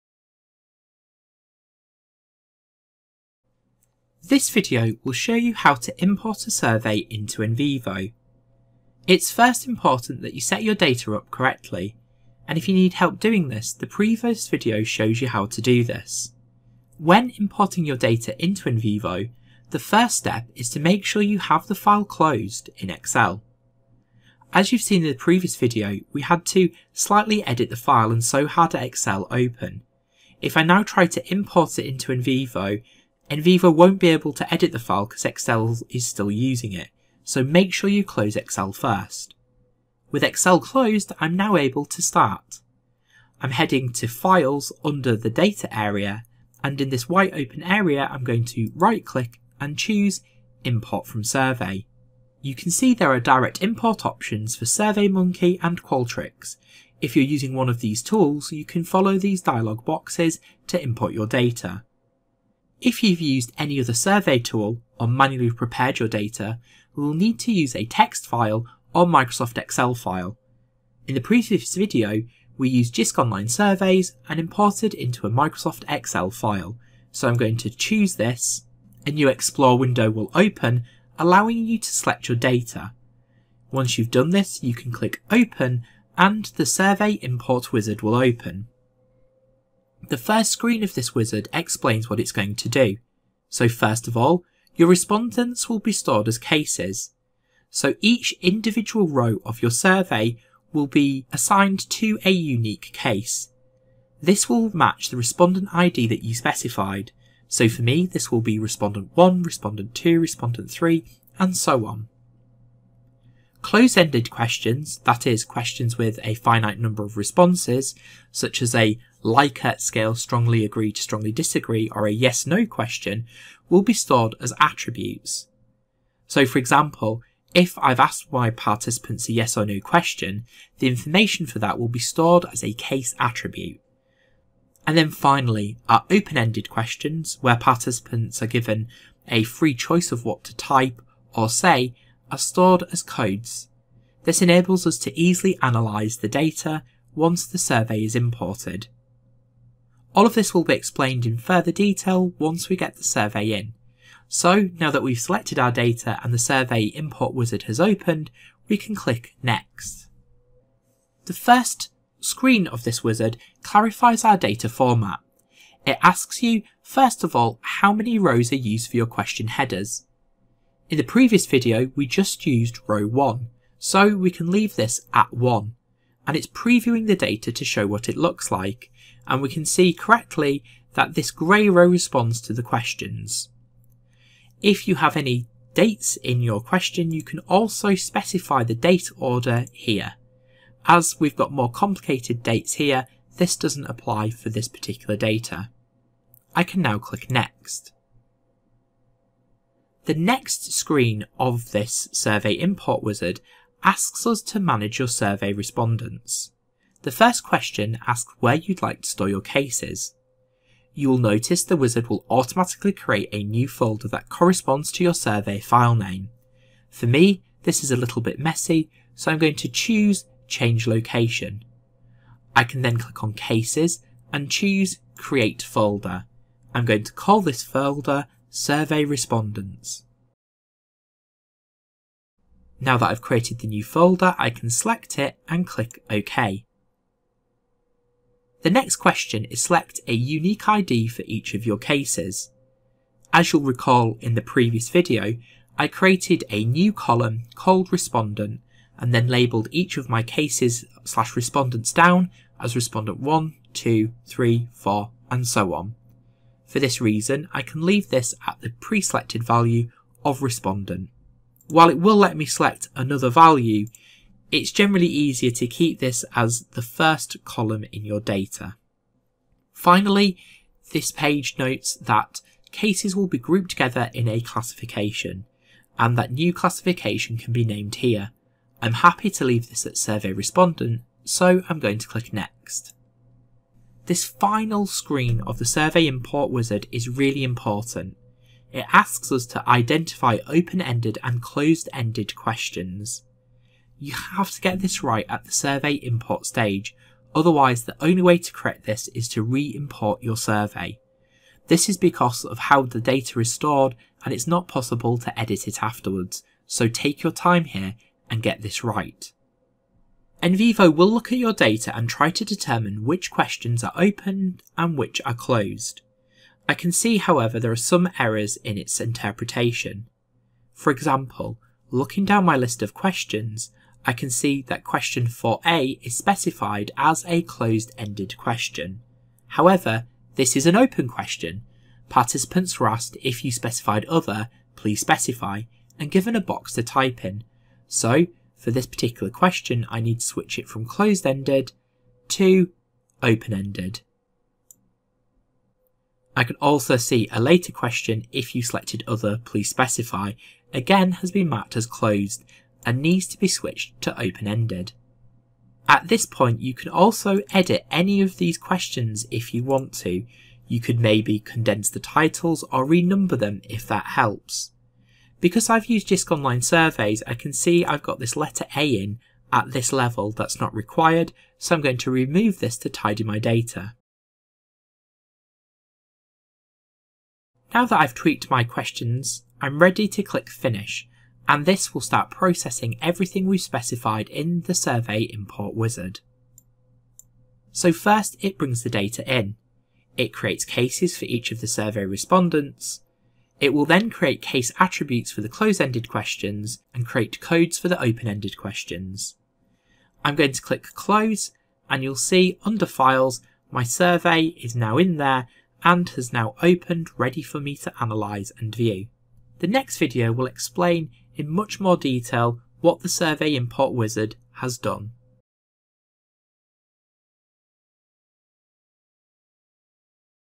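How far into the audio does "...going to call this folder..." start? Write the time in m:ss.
3:46.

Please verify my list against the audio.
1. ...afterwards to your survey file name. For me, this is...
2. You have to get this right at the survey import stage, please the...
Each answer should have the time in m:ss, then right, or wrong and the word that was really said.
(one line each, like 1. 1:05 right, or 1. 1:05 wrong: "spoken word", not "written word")
1. 3:34 wrong: "corresponds", not "afterwards"
2. 4:53 wrong: "otherwise", not "please".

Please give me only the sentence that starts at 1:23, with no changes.
Once you've done this, you can click Open and the Survey Import Wizard will open.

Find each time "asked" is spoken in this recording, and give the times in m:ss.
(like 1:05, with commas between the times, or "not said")
2:07, 5:32.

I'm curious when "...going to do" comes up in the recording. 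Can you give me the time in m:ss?
1:32.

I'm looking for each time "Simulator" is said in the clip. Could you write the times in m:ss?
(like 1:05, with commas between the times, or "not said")
not said.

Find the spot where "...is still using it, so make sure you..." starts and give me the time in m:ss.
0:35.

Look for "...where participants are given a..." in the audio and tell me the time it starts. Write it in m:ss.
2:17.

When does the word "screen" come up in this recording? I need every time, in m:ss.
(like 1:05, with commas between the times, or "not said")
1:30, 2:42, 3:20, 4:44.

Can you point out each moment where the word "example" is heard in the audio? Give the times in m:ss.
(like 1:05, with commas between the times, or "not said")
2:06, 5:20.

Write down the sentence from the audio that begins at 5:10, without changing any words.
NVivo will look at your data and try to determine which questions are open and which are closed.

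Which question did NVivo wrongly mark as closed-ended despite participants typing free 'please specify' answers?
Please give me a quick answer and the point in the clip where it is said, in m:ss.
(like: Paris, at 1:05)
Question 4a, at 5:24.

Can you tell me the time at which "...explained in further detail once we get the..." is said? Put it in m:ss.
2:30.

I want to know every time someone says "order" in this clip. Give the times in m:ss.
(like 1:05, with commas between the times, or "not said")
3:09.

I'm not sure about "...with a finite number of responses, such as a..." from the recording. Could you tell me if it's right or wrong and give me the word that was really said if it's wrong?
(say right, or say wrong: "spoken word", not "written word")
right.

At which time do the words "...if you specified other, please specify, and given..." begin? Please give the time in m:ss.
5:33.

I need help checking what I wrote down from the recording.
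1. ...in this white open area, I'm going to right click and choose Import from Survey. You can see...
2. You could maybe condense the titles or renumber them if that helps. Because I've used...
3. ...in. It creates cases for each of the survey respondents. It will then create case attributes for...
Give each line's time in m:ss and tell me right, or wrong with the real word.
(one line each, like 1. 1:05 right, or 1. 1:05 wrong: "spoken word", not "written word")
1. 0:46 right
2. 6:00 right
3. 6:29 right.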